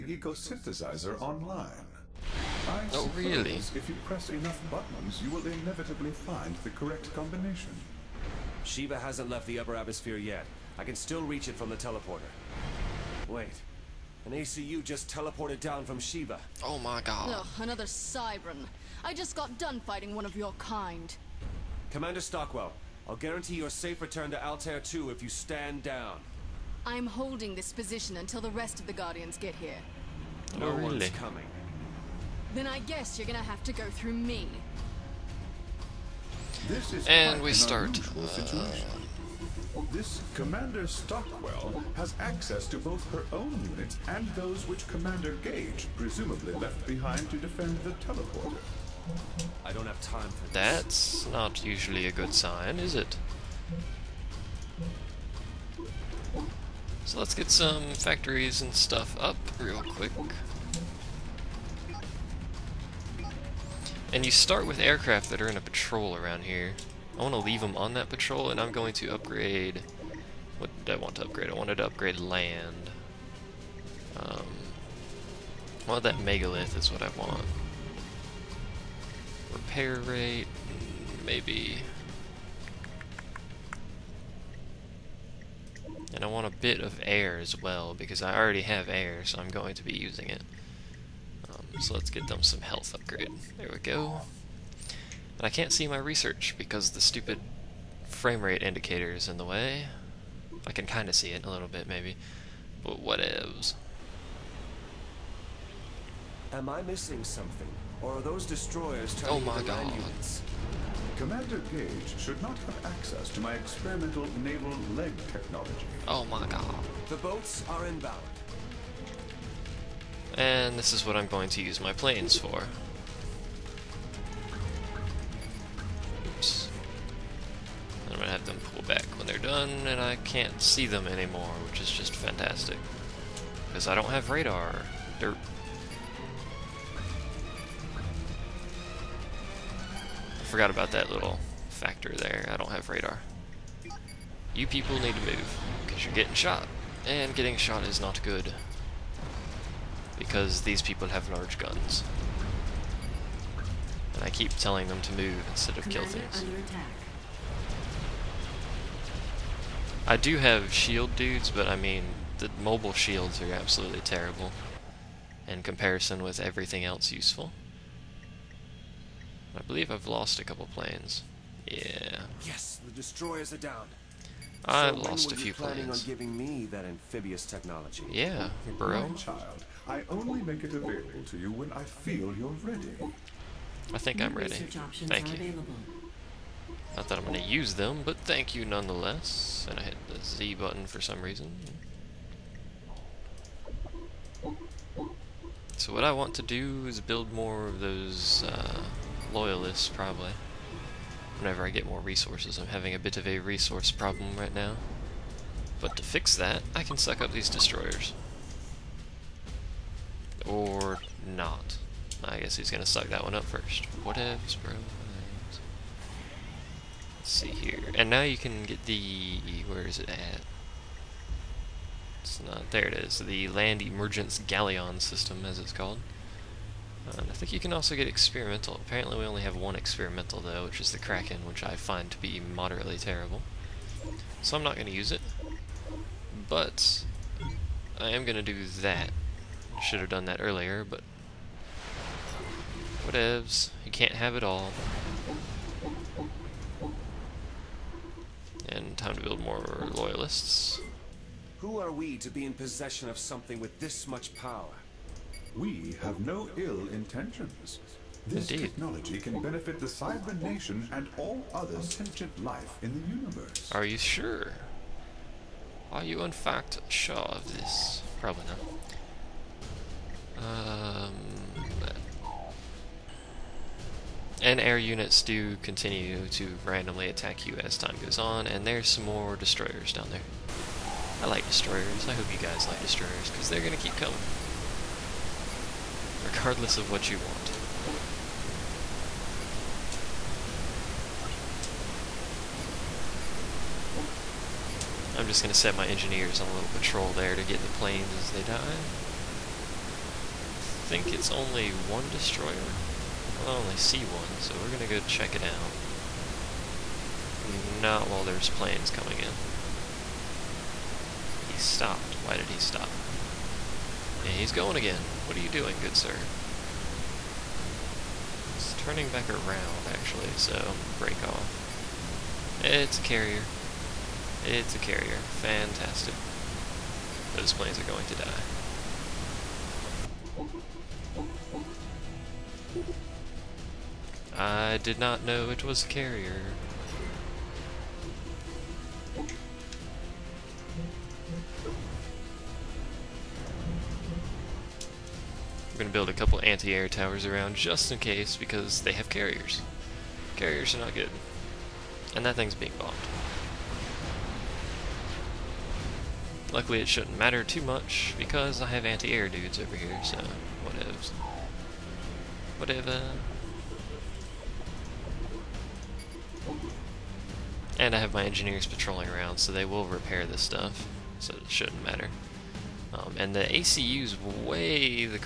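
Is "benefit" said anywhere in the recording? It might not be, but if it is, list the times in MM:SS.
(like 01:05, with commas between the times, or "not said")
04:19.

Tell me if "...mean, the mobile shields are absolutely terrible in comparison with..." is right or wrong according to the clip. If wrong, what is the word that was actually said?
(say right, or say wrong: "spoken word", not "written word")
right.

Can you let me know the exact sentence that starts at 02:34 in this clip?
And I keep telling them to move instead of kill things.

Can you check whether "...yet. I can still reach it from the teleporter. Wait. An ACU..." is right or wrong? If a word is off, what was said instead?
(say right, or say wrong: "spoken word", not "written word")
right.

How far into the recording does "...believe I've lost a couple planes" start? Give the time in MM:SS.
02:49.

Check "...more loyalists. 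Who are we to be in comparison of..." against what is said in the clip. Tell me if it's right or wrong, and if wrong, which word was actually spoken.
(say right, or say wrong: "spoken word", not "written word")
wrong: "possession", not "comparison".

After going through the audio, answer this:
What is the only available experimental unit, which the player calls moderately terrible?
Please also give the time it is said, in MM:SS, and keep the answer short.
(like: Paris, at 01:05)
Kraken, at 03:50.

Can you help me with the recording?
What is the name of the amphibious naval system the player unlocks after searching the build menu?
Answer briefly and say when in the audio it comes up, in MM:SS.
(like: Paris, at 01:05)
Land Emergence Galleon, at 03:43.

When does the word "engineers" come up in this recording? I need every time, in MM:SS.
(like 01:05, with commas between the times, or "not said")
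04:55, 06:08.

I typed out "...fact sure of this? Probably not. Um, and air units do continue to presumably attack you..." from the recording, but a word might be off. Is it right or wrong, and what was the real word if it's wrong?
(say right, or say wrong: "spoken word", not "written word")
wrong: "randomly", not "presumably".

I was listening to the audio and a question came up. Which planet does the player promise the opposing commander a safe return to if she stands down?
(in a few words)
Altair 2.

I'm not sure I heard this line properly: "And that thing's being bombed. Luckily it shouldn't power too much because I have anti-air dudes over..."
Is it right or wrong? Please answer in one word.
wrong.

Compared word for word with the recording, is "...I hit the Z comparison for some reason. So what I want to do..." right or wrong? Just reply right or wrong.
wrong.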